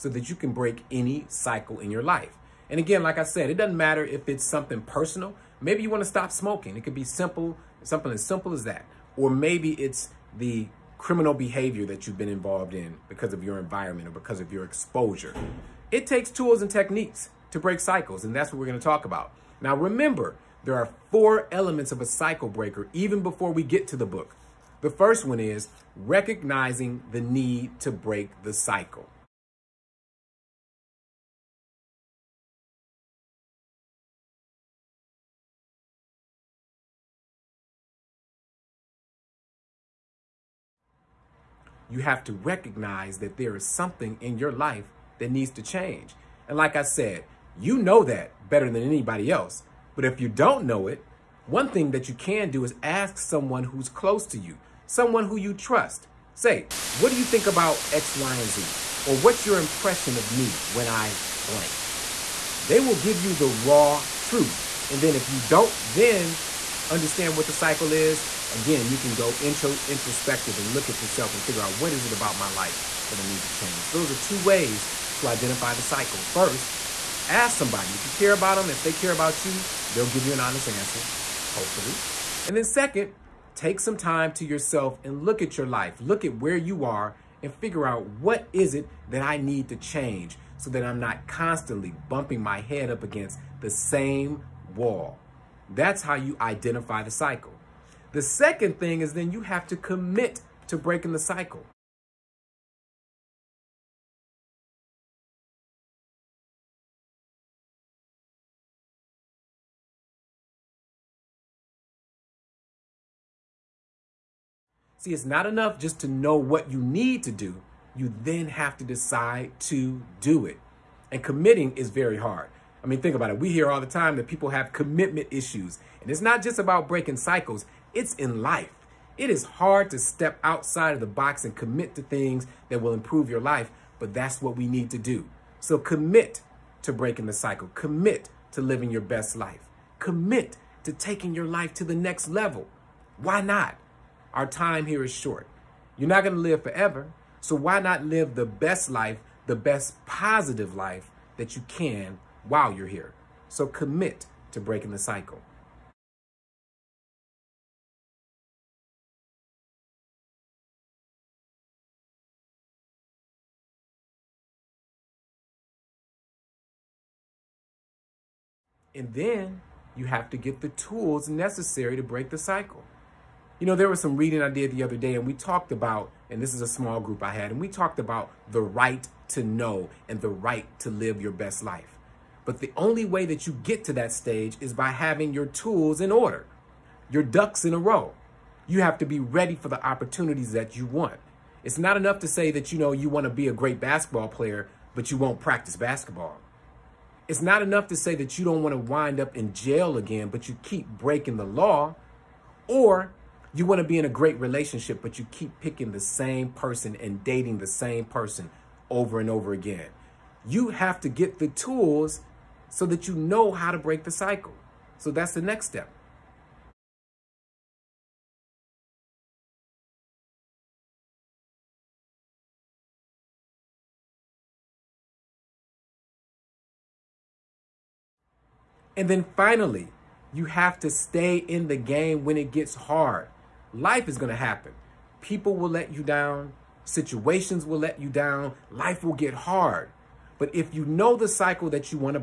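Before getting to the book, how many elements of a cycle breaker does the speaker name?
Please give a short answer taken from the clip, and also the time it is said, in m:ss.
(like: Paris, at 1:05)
4, at 0:21.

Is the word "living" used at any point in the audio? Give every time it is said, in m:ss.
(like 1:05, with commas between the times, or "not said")
2:18.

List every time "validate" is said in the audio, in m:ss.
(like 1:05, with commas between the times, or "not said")
not said.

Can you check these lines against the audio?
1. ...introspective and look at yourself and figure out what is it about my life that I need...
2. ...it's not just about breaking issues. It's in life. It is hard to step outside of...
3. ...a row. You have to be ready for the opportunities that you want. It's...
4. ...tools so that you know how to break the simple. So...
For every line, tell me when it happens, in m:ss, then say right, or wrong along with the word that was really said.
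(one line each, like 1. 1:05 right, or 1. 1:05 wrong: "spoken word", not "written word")
1. 1:09 right
2. 2:06 wrong: "cycles", not "issues"
3. 3:07 right
4. 3:31 wrong: "cycle", not "simple".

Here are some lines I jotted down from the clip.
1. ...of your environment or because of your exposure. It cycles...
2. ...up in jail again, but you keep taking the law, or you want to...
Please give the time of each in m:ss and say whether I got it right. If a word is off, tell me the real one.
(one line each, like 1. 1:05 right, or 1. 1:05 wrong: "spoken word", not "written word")
1. 0:13 wrong: "takes", not "cycles"
2. 3:19 wrong: "breaking", not "taking".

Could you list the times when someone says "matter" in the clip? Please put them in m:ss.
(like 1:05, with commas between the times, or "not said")
0:03.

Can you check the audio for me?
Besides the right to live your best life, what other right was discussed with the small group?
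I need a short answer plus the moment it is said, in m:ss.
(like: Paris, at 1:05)
the right to know, at 2:58.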